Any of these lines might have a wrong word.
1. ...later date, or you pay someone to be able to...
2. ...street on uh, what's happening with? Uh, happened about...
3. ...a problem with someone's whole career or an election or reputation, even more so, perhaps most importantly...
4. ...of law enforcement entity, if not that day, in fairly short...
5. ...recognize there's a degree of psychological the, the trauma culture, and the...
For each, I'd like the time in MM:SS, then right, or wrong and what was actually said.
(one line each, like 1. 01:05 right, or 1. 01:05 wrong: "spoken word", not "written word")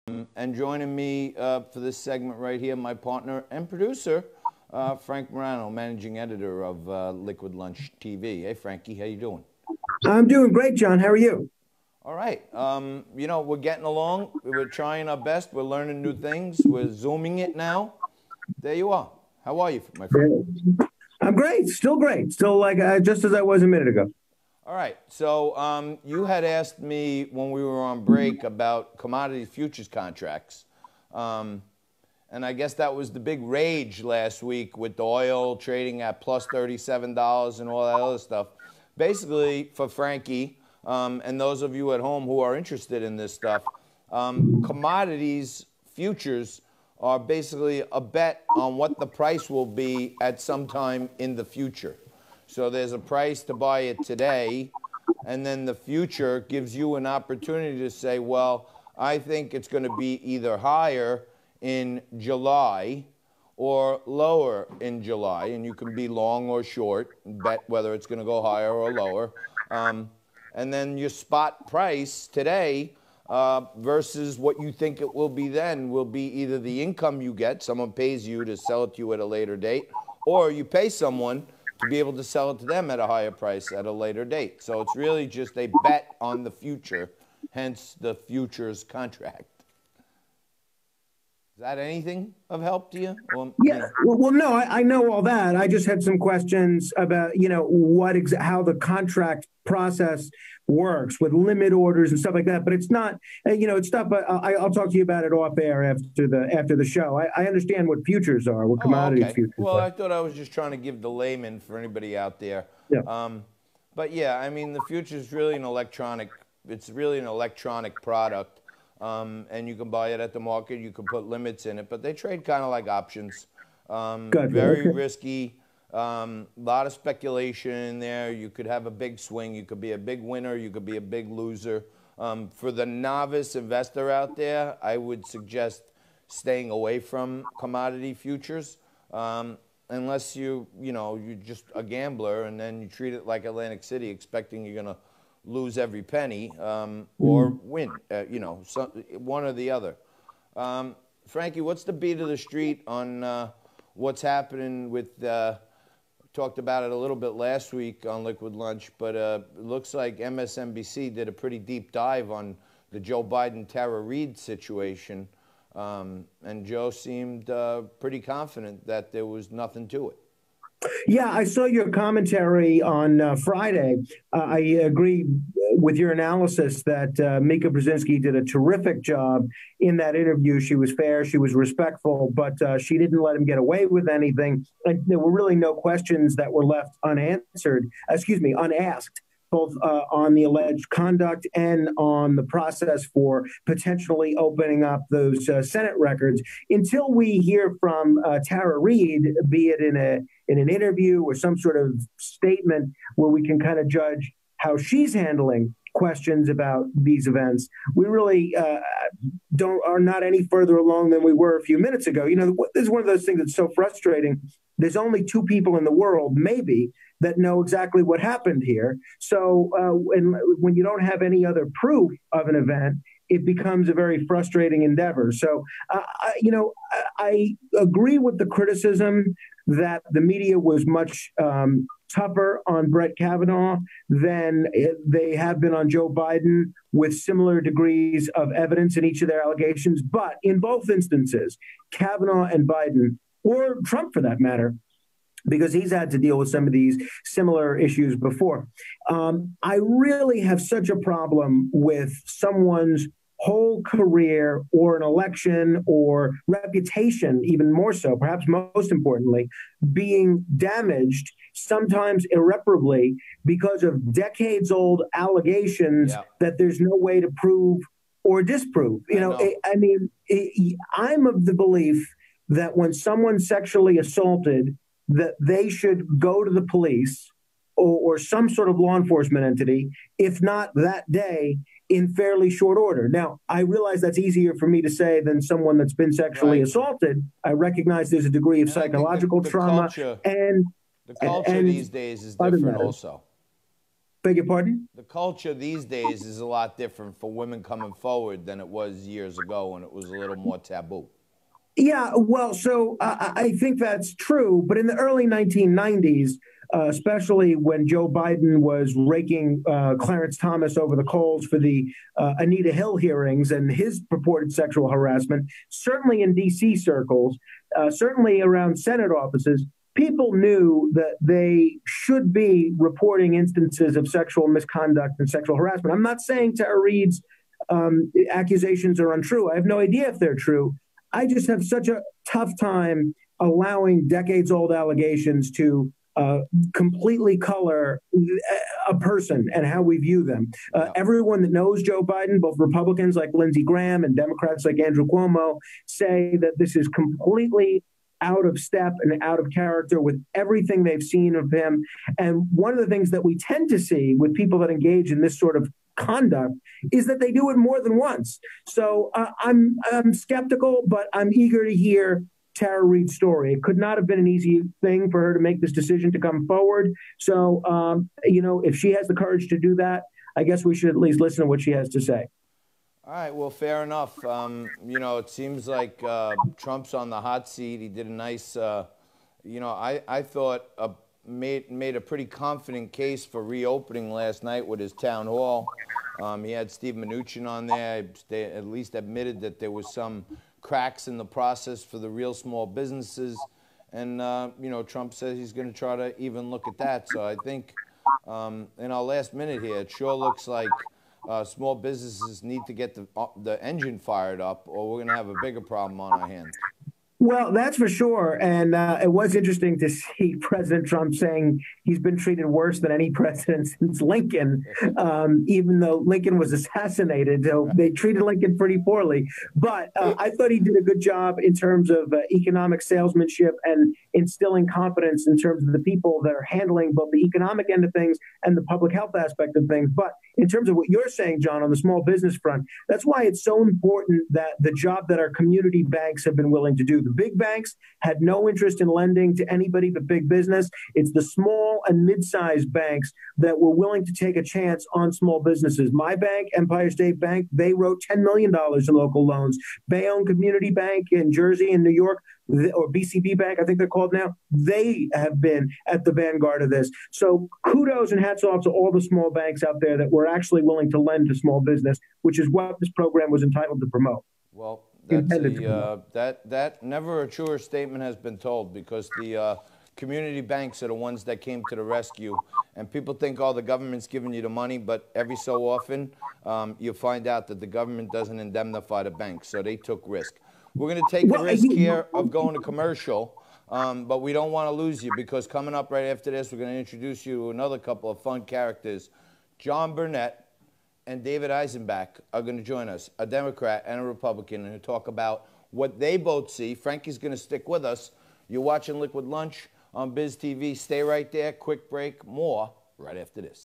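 1. 01:19 right
2. 02:32 wrong: "talked", not "happened"
3. 04:10 right
4. 04:38 right
5. 04:47 right.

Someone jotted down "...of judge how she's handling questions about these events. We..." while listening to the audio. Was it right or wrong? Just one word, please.
right.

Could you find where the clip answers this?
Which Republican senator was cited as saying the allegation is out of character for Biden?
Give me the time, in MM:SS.
05:43.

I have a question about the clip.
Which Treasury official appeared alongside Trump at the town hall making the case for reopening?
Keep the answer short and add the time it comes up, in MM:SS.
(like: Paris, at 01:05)
Steve Mnuchin, at 06:26.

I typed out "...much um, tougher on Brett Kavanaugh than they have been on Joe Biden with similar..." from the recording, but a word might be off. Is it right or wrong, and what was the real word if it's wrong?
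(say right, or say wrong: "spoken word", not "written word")
right.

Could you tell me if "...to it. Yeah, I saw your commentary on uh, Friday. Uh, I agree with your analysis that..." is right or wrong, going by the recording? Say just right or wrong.
right.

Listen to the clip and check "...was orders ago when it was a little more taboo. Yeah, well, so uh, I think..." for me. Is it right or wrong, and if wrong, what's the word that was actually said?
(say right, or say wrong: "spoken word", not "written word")
wrong: "years", not "orders".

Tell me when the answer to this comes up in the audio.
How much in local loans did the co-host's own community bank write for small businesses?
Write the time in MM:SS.
07:28.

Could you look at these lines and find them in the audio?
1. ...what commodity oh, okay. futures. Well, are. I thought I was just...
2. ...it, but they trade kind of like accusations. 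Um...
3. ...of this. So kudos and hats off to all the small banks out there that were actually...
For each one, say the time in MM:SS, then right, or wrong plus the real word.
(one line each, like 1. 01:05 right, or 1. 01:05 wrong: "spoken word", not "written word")
1. 01:48 right
2. 02:01 wrong: "options", not "accusations"
3. 07:36 right.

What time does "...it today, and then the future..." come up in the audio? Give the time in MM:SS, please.
00:53.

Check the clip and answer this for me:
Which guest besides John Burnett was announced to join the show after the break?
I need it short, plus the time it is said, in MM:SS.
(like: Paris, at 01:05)
David Eisenbach, at 08:11.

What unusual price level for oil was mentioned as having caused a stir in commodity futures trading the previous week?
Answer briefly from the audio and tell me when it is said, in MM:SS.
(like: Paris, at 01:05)
plus $37, at 00:36.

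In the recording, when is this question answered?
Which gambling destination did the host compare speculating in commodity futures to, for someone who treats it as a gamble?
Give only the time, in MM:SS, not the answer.
02:23.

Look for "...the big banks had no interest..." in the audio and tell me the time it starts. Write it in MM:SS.
07:17.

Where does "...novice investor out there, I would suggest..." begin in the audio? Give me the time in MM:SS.
02:12.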